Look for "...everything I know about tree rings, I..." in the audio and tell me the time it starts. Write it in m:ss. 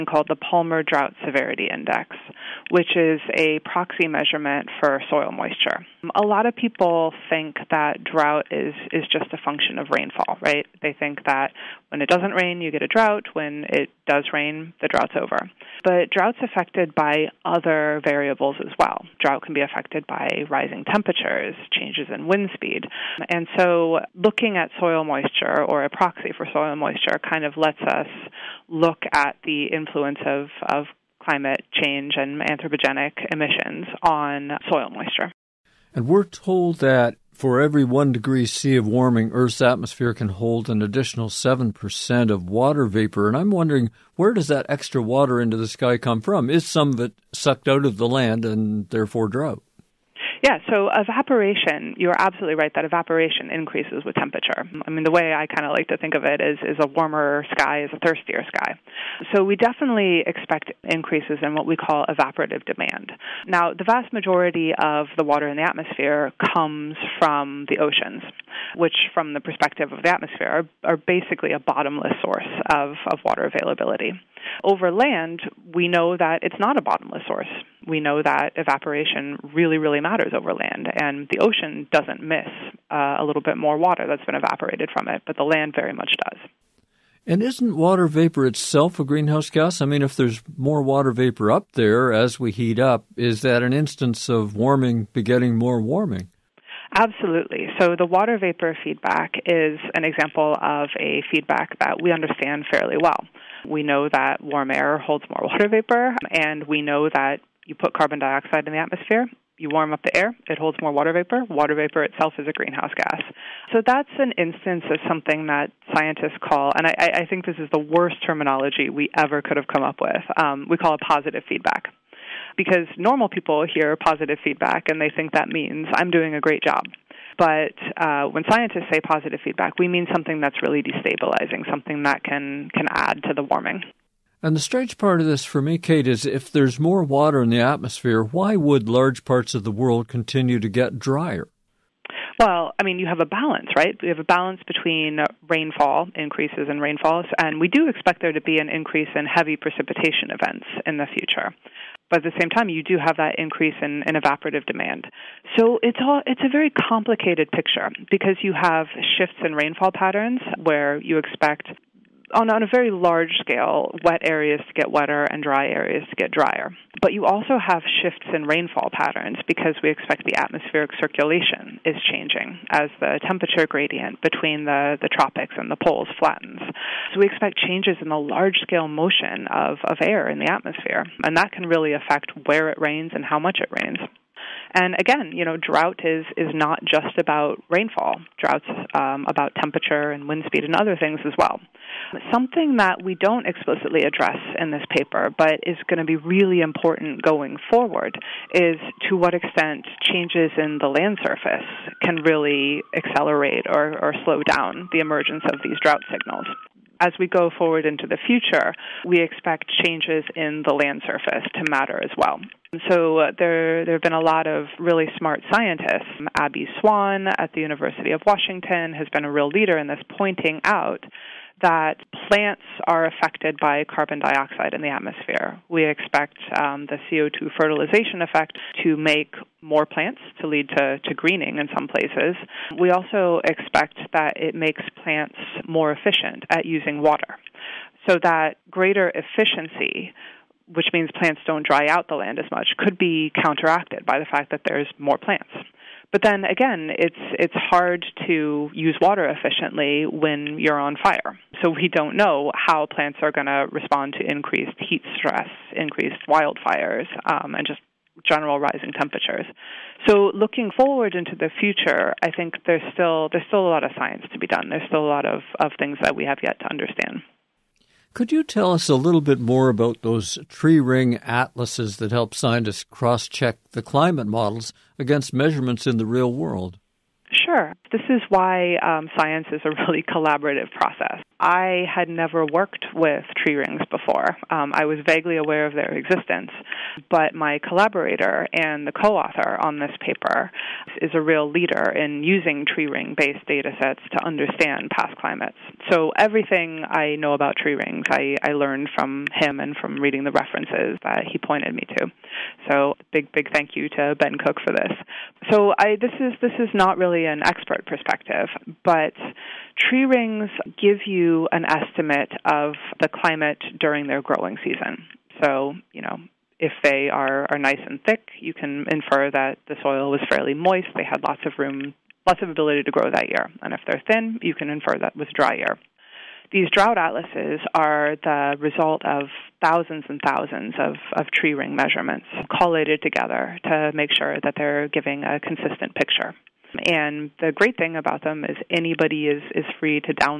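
4:56.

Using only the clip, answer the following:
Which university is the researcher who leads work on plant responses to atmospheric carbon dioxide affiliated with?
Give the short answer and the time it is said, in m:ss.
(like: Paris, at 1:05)
University of Washington, at 3:37.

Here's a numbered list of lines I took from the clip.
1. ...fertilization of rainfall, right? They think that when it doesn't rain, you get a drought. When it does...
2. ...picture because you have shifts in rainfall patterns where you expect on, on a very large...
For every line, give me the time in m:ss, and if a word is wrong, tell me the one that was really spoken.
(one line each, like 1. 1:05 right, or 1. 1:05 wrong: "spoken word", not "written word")
1. 0:09 wrong: "function", not "fertilization"
2. 2:37 right.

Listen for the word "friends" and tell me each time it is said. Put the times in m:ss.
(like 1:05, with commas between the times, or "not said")
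not said.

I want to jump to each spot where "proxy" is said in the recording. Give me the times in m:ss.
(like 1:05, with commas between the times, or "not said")
0:03, 0:25.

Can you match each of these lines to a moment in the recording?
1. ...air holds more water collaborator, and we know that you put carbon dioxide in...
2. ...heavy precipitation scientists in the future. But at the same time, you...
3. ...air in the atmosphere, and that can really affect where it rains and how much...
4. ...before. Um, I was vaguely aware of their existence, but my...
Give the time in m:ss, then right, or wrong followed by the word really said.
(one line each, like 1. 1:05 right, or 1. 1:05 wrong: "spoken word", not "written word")
1. 1:44 wrong: "vapor", not "collaborator"
2. 2:29 wrong: "events", not "scientists"
3. 3:00 right
4. 4:43 right.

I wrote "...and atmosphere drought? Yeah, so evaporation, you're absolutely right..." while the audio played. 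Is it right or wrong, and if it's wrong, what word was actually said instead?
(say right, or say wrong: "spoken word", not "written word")
wrong: "therefore", not "atmosphere".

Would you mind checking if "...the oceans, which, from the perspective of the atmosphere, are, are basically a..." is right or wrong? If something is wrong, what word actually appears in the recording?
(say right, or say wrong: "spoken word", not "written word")
right.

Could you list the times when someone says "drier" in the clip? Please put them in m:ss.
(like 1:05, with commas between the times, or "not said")
2:20, 2:46.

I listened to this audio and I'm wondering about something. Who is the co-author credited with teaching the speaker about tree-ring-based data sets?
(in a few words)
Ben Cook.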